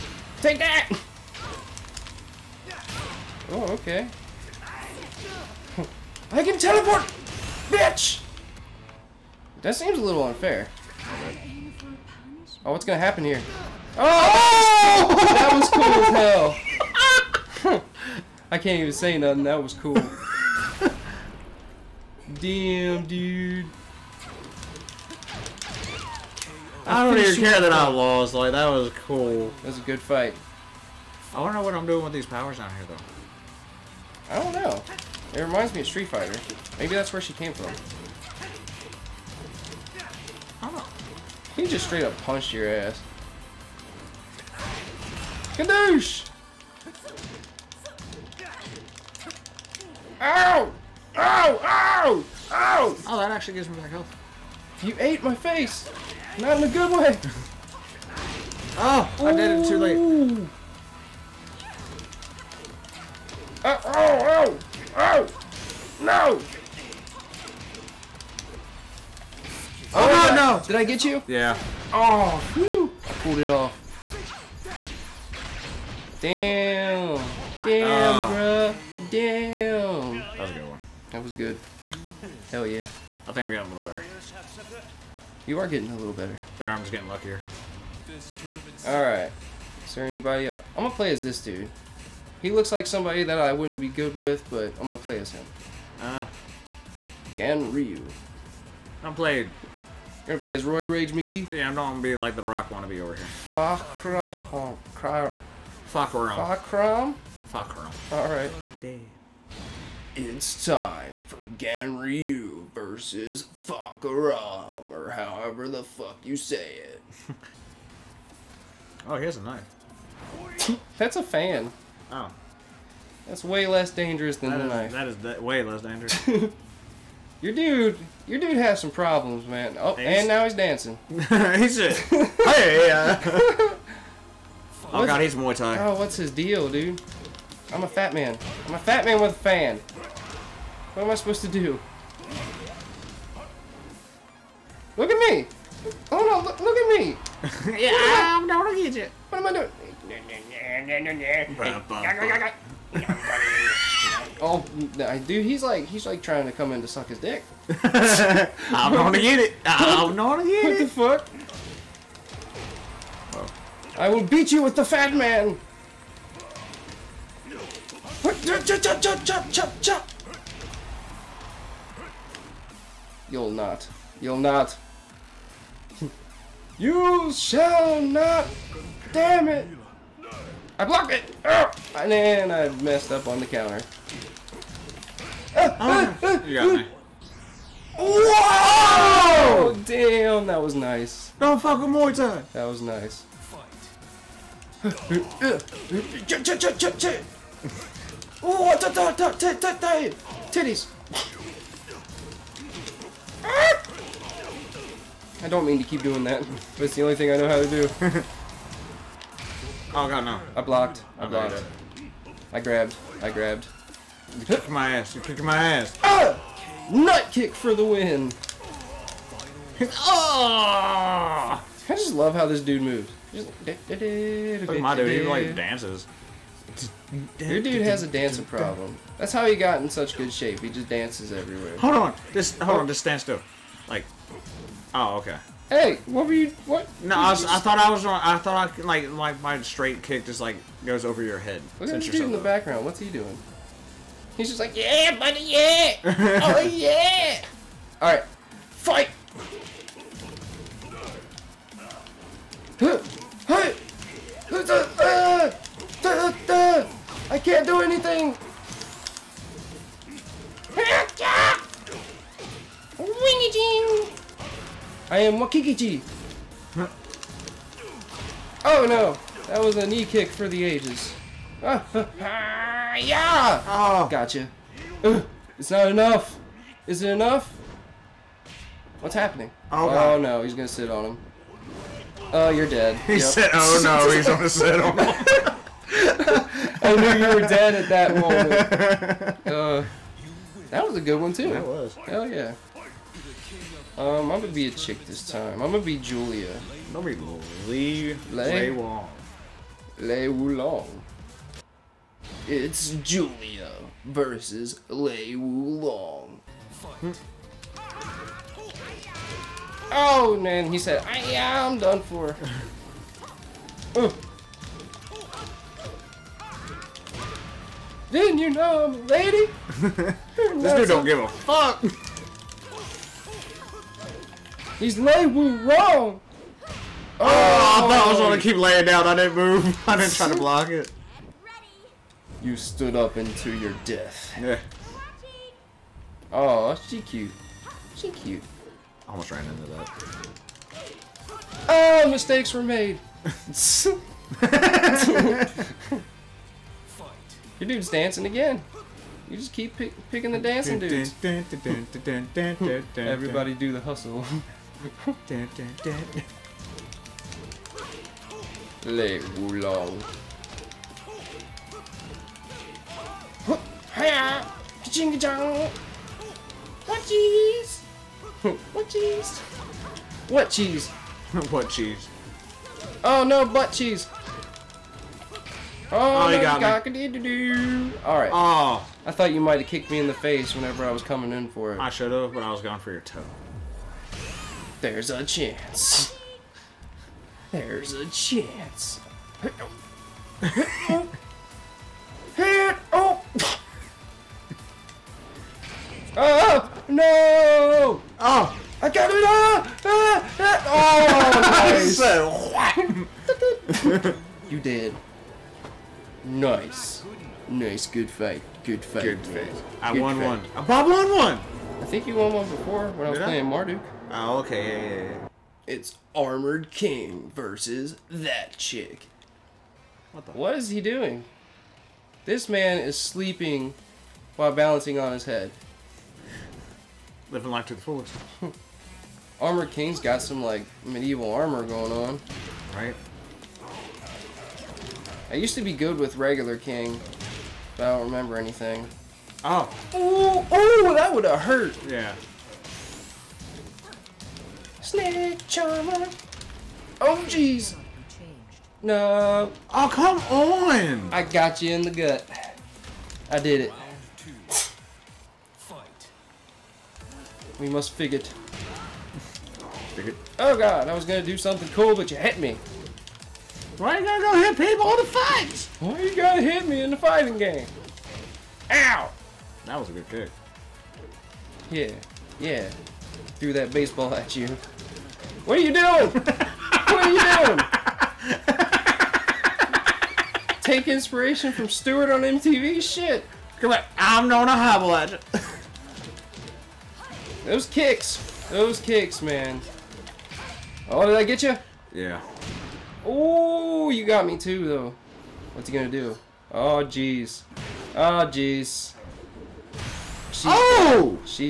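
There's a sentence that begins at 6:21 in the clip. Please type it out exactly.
I should have, but I was going for your toe.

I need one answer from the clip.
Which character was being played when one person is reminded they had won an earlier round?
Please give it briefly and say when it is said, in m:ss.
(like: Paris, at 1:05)
Marduk, at 6:53.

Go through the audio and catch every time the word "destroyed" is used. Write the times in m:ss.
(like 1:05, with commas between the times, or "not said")
not said.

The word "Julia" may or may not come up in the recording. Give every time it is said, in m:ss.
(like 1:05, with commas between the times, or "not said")
4:55, 5:03.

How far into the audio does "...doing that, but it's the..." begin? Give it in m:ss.
3:26.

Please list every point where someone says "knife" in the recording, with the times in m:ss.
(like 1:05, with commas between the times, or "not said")
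1:59, 2:04.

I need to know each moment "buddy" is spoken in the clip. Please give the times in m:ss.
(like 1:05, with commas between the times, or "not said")
4:05.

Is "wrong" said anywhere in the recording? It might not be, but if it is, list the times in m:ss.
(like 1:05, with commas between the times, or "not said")
3:58, 5:25.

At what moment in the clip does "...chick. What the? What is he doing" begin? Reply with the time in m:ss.
6:58.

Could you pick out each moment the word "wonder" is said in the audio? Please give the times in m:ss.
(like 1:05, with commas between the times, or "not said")
0:31.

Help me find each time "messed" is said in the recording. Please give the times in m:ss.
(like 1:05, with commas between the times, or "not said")
3:02.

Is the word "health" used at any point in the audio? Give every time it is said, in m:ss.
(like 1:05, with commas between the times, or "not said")
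0:53.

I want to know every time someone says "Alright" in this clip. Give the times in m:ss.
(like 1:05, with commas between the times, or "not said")
1:28, 1:48.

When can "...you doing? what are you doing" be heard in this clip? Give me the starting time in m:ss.
7:55.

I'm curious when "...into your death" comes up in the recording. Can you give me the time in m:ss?
5:33.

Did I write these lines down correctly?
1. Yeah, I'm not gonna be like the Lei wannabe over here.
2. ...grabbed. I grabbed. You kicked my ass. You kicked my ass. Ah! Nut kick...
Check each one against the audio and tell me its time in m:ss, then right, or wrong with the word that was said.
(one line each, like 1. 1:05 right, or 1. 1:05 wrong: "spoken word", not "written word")
1. 1:41 wrong: "Rock", not "Lei"
2. 3:32 right.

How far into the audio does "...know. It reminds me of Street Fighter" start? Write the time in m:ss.
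0:34.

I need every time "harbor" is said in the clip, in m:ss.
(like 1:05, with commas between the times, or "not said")
not said.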